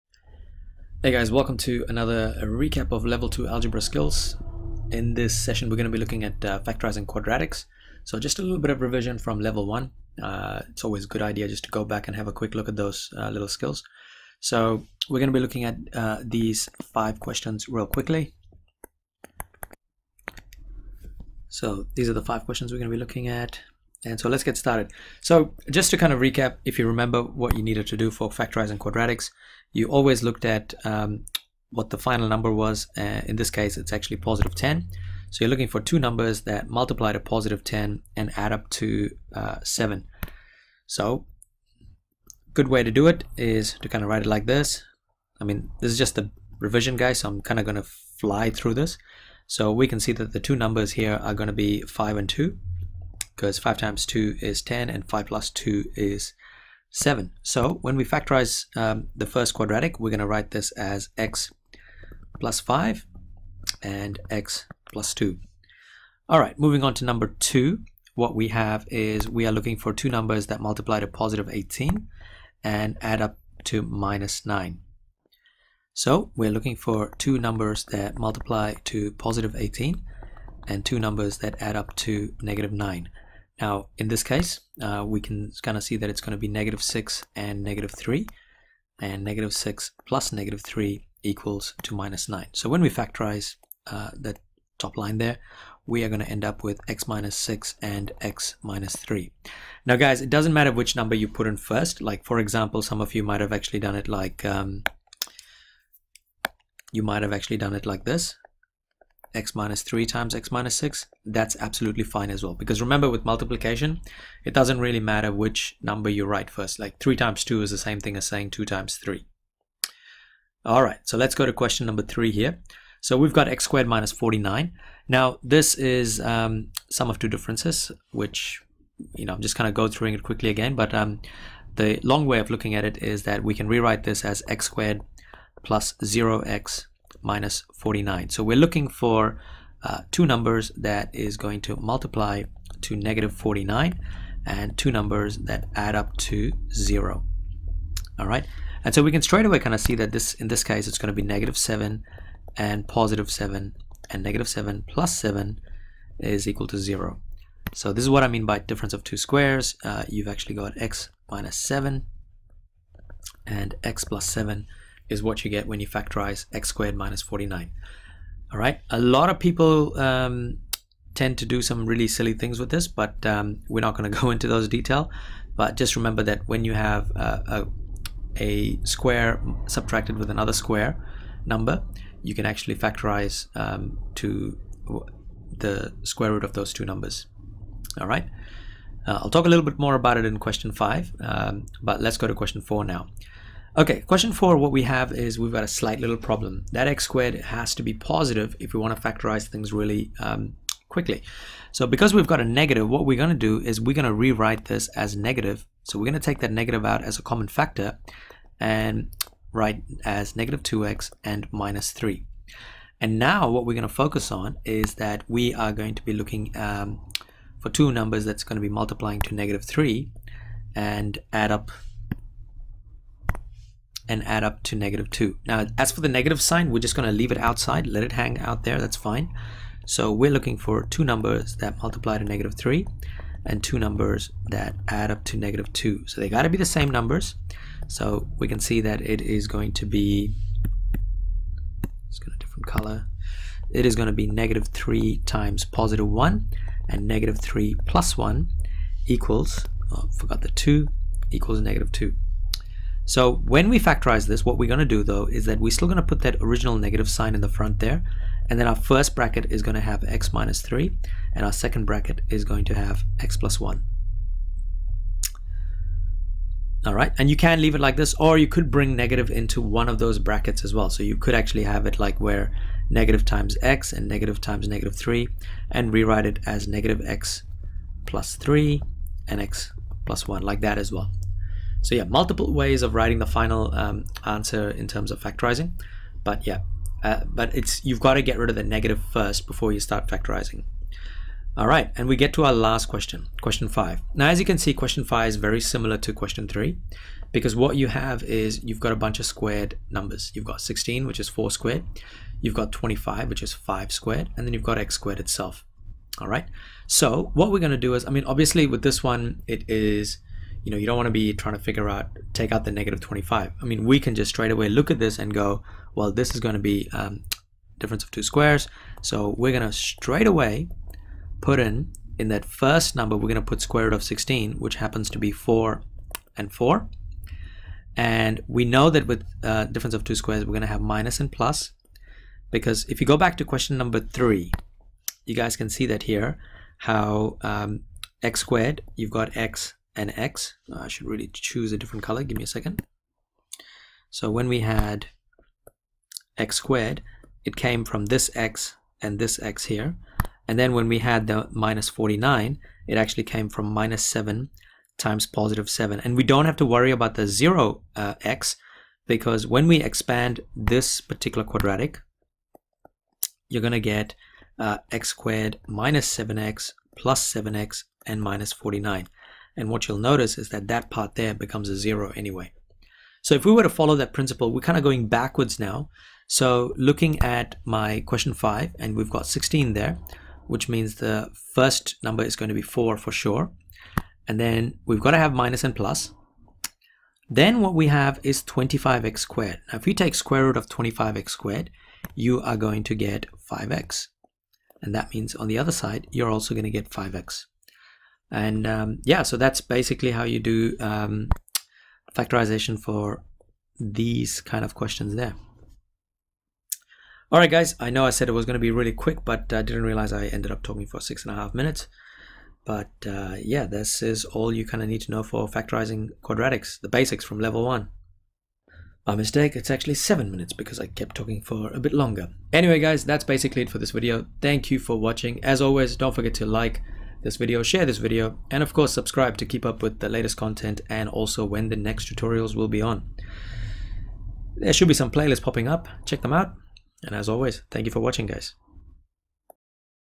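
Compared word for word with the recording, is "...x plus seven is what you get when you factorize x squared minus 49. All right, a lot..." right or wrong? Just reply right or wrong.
right.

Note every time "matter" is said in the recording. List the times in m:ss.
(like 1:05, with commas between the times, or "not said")
1:40, 1:54.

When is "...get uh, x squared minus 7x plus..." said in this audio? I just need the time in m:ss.
6:03.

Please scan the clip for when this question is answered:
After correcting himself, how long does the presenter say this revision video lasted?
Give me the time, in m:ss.
6:59.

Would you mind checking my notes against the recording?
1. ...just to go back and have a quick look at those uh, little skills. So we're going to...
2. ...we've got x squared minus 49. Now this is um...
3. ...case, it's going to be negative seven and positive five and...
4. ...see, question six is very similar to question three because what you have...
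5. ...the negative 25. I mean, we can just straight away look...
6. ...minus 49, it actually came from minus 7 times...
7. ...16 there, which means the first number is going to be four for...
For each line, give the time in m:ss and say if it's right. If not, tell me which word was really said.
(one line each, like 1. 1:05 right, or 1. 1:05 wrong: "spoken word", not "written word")
1. 0:11 right
2. 2:03 right
3. 2:30 wrong: "seven", not "five"
4. 4:54 wrong: "five", not "six"
5. 5:12 right
6. 5:51 right
7. 6:19 right.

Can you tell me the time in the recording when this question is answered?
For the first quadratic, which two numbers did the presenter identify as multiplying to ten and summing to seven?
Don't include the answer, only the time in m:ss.
0:51.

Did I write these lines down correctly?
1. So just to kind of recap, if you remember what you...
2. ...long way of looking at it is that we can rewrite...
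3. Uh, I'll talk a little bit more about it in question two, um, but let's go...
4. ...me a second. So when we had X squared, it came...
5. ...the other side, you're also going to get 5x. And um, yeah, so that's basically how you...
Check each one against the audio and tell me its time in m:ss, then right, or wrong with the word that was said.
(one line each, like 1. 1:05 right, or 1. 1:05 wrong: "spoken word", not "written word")
1. 0:25 right
2. 2:12 right
3. 3:09 wrong: "five", not "two"
4. 5:42 right
5. 6:35 right.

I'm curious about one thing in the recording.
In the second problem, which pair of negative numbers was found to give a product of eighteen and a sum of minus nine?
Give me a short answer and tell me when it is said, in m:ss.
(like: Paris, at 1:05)
-6 and -3, at 1:26.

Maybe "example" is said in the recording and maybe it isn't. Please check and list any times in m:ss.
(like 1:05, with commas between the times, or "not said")
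1:42.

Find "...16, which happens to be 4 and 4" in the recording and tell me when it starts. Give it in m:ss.
5:24.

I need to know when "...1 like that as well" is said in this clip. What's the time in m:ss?
4:40.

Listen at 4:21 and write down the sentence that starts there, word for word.
And our second bracket is going to have x plus 1.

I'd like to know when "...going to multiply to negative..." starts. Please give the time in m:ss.
2:21.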